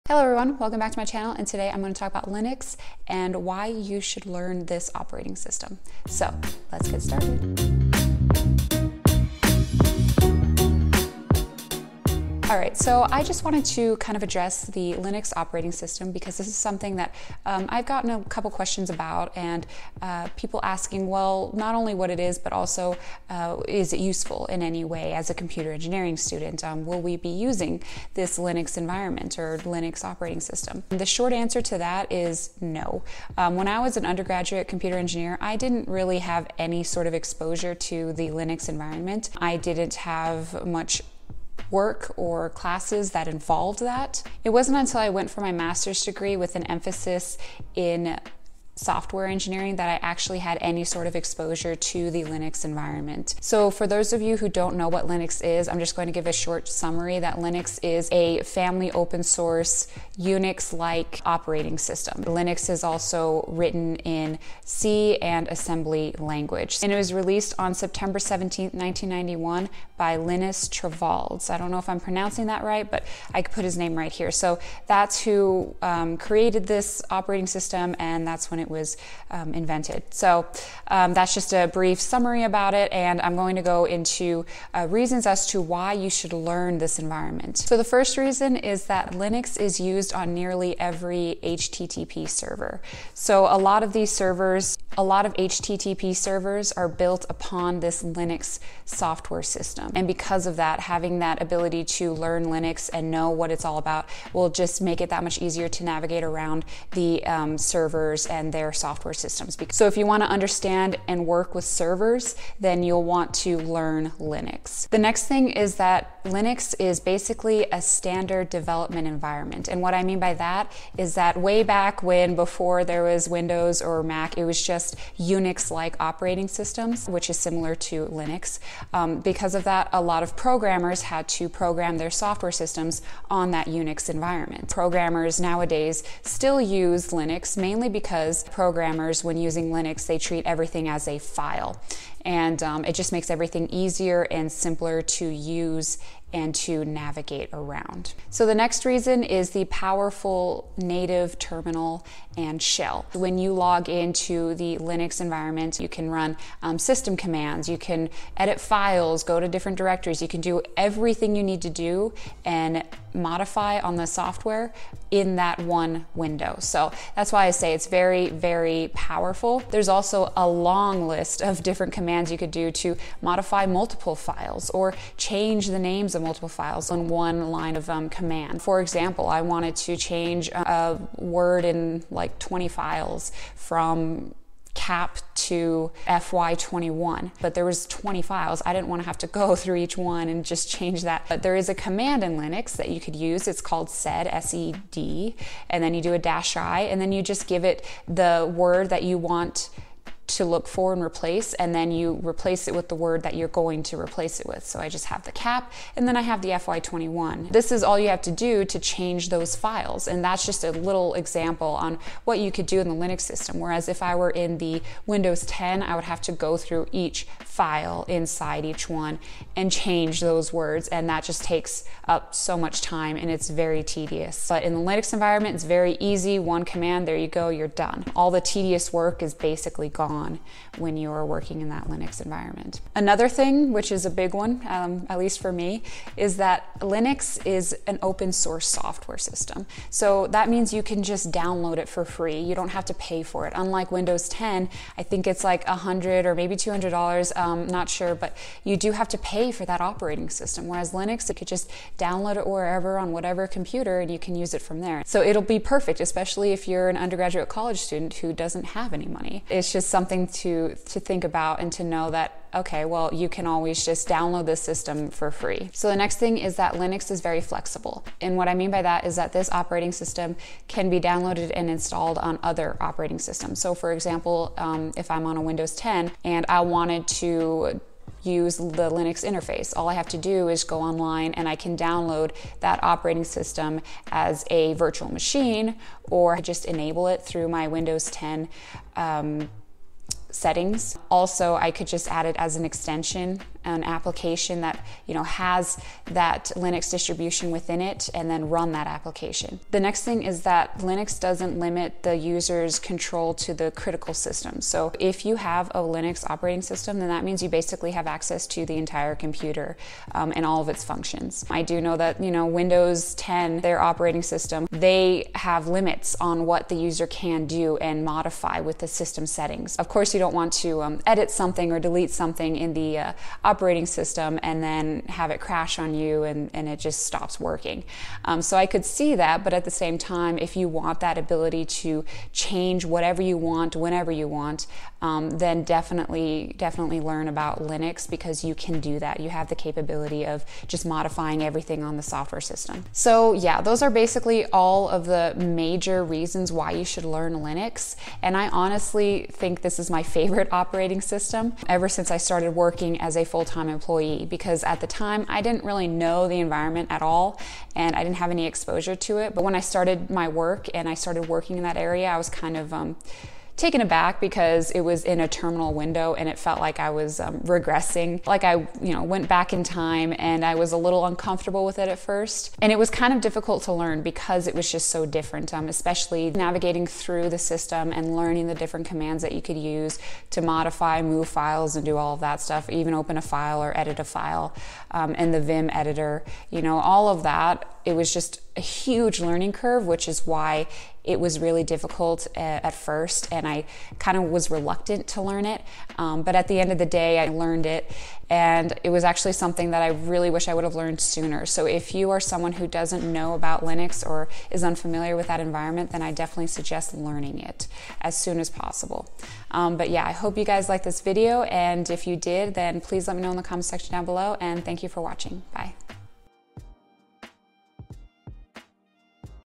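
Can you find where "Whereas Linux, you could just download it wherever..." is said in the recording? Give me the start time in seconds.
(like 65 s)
250 s.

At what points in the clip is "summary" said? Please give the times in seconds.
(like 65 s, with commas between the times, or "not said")
56 s, 81 s.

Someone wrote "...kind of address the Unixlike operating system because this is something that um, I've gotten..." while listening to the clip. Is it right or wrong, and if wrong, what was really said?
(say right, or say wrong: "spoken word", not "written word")
wrong: "Linux", not "Unixlike".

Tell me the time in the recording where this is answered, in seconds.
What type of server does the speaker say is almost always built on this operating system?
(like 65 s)
91 s.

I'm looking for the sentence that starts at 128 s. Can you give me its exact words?
Um, because of that, a lot of programmers had to program their software systems on that Unix environment.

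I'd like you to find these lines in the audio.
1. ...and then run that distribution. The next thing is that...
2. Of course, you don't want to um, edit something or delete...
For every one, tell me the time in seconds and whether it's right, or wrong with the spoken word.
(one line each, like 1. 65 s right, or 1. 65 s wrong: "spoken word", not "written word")
1. 298 s wrong: "application", not "distribution"
2. 319 s right.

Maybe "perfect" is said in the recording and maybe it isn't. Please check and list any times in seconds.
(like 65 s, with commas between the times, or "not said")
255 s.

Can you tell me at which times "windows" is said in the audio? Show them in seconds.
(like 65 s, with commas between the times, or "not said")
123 s, 166 s, 215 s, 243 s, 275 s, 287 s, 312 s, 365 s.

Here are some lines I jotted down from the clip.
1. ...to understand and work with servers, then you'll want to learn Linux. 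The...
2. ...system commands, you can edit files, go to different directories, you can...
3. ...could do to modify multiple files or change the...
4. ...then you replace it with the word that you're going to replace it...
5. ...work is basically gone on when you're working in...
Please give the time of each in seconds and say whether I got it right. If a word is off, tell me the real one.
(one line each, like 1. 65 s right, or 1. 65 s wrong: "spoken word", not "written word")
1. 110 s right
2. 156 s right
3. 172 s right
4. 201 s right
5. 228 s right.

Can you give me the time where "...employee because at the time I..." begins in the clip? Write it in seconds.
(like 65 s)
353 s.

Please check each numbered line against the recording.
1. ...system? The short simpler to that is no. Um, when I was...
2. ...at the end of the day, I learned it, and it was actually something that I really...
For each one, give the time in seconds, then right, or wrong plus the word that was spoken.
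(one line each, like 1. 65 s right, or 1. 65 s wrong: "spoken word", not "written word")
1. 30 s wrong: "answer", not "simpler"
2. 396 s right.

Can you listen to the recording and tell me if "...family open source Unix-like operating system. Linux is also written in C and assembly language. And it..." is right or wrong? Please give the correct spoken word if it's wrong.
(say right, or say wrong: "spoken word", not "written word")
right.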